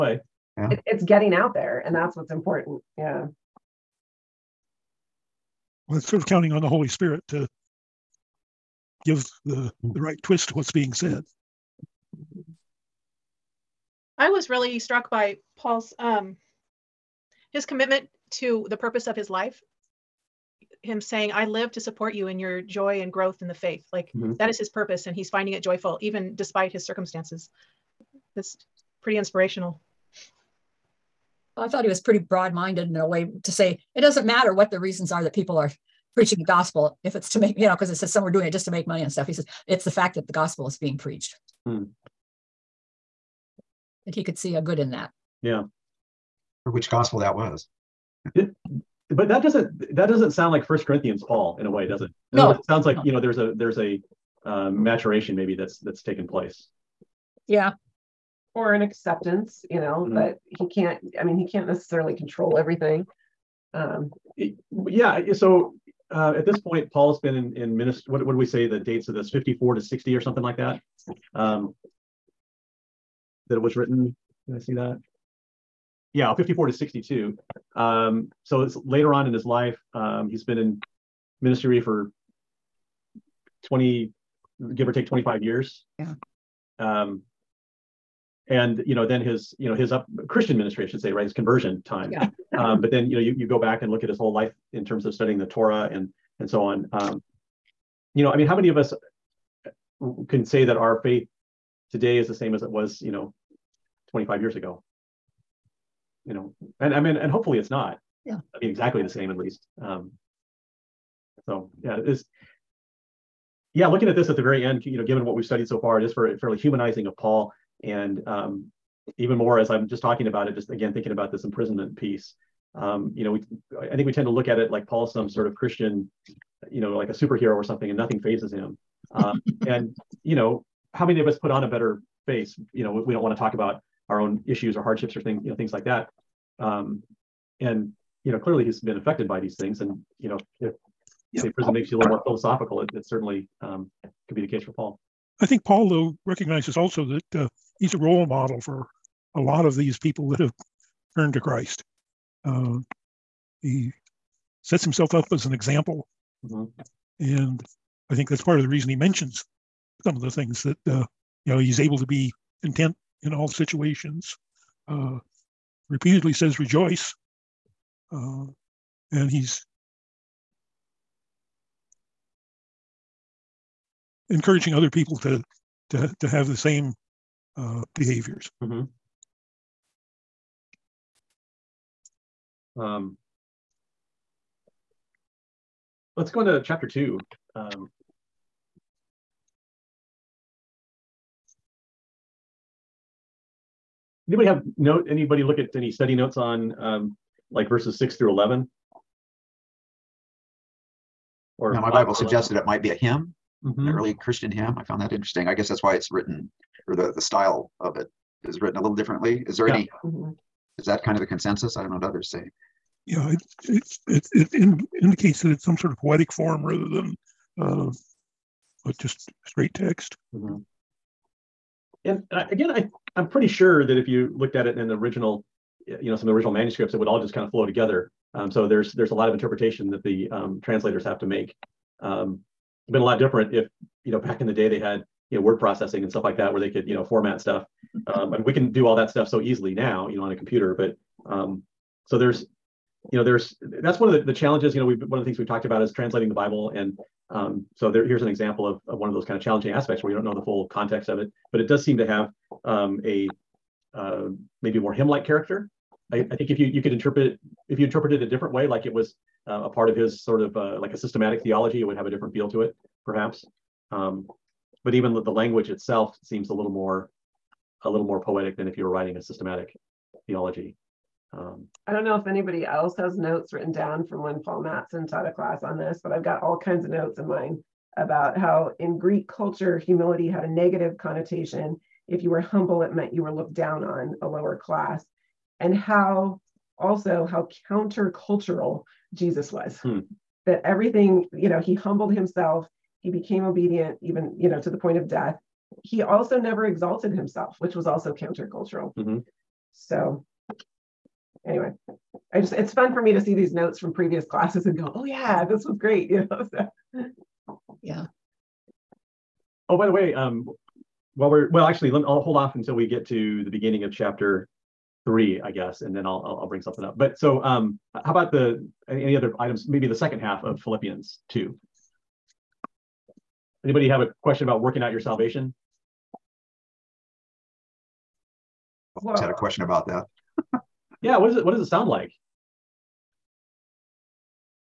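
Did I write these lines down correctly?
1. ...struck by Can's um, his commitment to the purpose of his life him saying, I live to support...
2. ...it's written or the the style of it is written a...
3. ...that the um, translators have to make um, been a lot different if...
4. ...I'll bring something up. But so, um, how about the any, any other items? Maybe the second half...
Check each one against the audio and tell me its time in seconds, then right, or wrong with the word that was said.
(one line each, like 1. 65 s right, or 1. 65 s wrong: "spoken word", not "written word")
1. 14 s wrong: "Paul", not "Can"
2. 205 s right
3. 229 s right
4. 316 s right.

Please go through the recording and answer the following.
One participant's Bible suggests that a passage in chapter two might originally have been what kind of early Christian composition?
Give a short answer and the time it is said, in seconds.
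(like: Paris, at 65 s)
A hymn, at 202 s.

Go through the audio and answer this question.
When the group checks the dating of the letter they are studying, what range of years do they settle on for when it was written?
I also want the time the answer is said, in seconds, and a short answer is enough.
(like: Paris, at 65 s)
54 to 62, at 76 s.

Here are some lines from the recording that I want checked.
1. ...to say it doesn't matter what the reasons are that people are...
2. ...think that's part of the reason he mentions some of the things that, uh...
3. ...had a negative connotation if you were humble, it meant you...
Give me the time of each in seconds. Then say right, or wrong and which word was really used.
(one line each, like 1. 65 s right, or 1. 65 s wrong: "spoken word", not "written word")
1. 33 s right
2. 158 s right
3. 280 s right.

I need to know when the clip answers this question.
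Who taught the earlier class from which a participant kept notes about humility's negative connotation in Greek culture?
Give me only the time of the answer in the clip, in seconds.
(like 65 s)
274 s.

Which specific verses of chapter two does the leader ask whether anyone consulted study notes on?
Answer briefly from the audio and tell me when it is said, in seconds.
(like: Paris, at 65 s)
6 through 11, at 197 s.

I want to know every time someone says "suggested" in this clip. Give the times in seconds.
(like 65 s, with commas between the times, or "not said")
202 s.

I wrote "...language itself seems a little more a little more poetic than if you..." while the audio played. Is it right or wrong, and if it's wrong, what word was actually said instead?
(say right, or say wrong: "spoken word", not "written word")
right.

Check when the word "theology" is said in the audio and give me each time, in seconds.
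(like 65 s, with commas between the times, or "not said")
261 s, 270 s.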